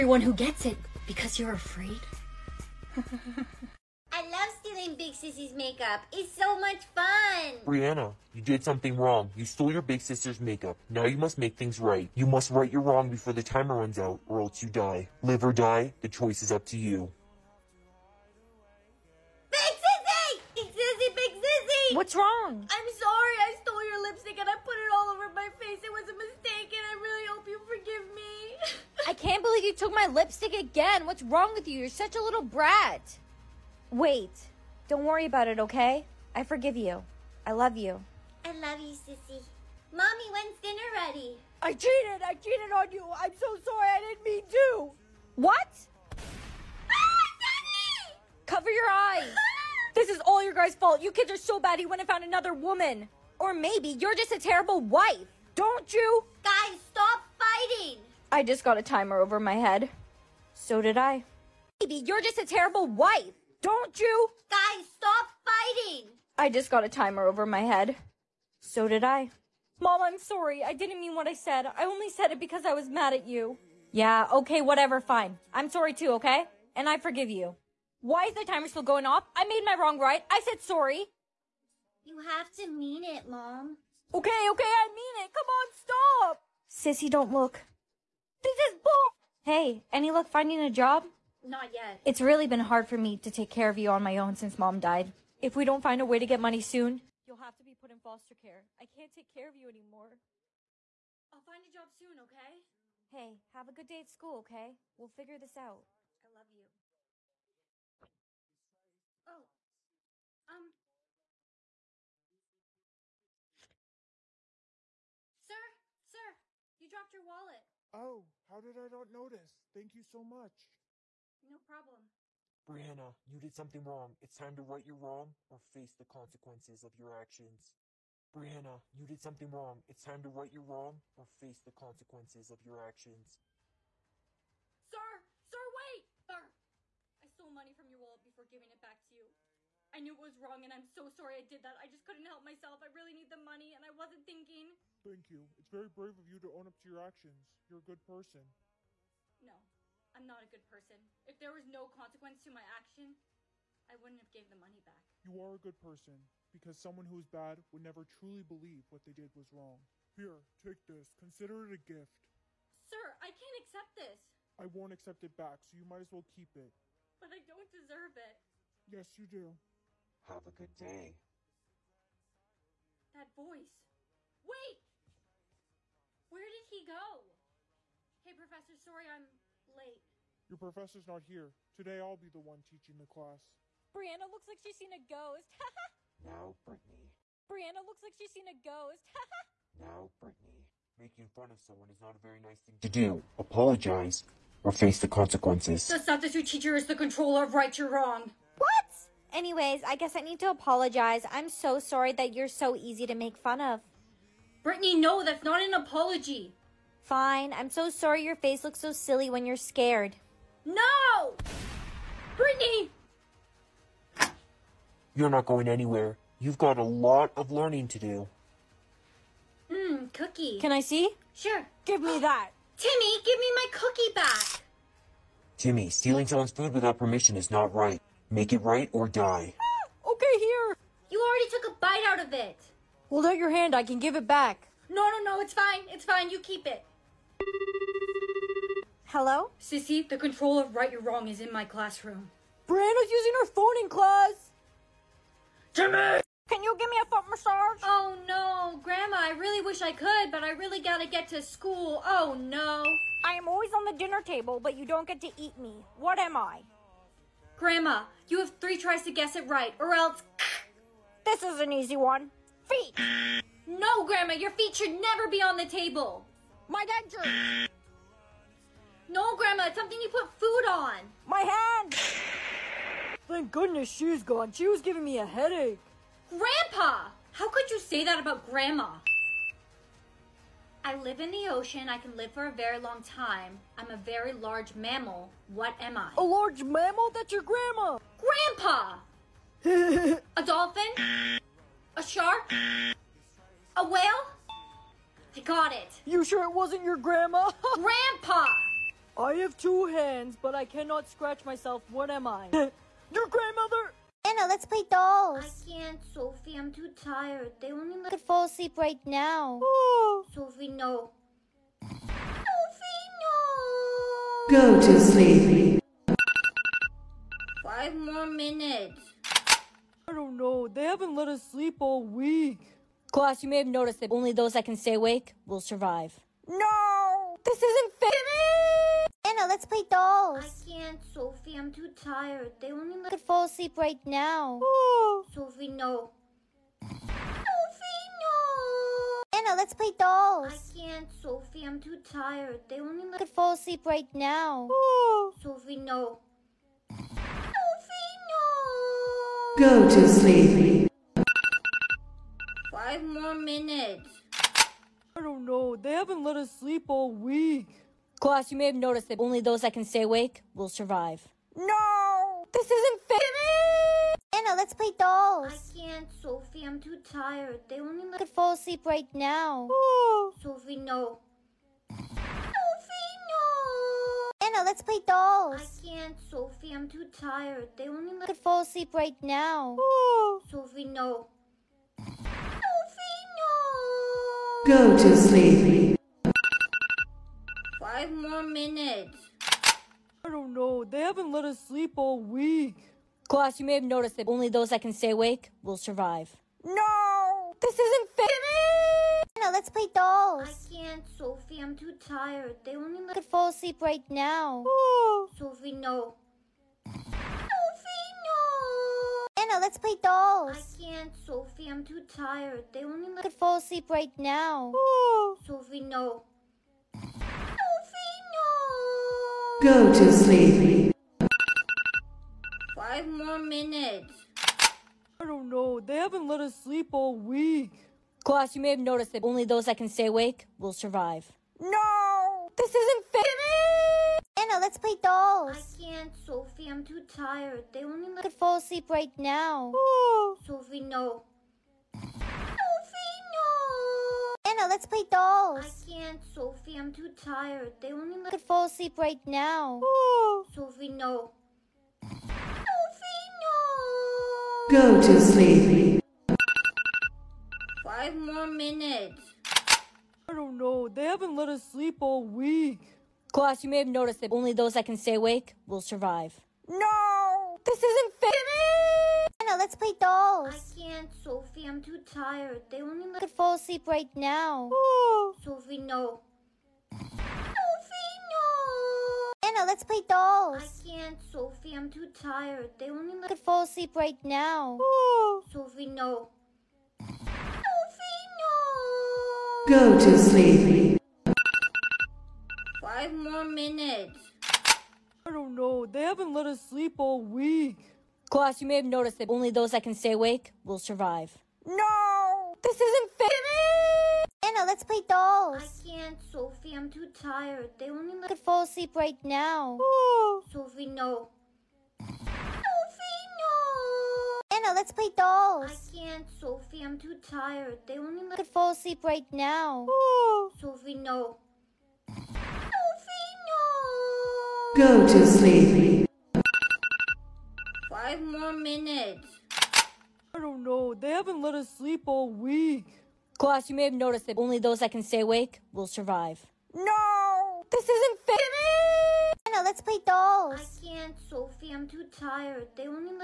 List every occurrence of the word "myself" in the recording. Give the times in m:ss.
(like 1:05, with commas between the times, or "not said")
2:22, 5:01.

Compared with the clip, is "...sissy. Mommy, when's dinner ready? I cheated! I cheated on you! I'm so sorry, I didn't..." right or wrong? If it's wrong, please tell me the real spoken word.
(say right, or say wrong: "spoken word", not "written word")
right.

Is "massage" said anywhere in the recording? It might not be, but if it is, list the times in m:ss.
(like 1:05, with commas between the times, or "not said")
4:07.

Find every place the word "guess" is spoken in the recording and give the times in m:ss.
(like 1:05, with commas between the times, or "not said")
3:19, 4:19.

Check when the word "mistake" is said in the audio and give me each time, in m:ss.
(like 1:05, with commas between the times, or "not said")
0:26.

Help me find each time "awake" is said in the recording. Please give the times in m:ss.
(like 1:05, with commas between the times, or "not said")
5:24, 6:00, 6:35, 7:10, 7:45, 8:20, 8:55.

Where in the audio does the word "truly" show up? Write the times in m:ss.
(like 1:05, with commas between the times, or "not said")
2:38.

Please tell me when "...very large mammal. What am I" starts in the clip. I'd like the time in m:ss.
4:43.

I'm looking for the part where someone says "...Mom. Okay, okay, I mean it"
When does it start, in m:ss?
1:23.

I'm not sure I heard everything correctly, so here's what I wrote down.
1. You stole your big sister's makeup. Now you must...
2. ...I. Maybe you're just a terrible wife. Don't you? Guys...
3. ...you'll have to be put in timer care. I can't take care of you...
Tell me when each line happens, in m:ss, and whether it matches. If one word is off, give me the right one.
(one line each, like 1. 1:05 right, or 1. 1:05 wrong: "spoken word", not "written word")
1. 0:09 right
2. 1:00 right
3. 1:37 wrong: "foster", not "timer".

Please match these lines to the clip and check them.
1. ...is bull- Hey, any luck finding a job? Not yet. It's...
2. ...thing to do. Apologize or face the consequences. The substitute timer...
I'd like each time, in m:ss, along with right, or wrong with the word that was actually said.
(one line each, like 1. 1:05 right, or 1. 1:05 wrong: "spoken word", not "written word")
1. 1:28 right
2. 3:12 wrong: "teacher", not "timer".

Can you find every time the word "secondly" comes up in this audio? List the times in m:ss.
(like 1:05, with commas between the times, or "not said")
not said.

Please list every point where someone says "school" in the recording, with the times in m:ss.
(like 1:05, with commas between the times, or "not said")
1:44, 4:11.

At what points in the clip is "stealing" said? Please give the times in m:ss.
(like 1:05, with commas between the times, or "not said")
0:04, 3:45.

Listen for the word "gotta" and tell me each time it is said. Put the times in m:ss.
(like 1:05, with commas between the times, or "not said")
4:10.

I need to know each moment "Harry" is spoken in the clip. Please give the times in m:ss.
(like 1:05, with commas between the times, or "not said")
not said.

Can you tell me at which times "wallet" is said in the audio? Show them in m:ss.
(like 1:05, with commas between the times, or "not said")
1:57, 2:18.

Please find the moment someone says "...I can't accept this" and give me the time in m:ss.
2:43.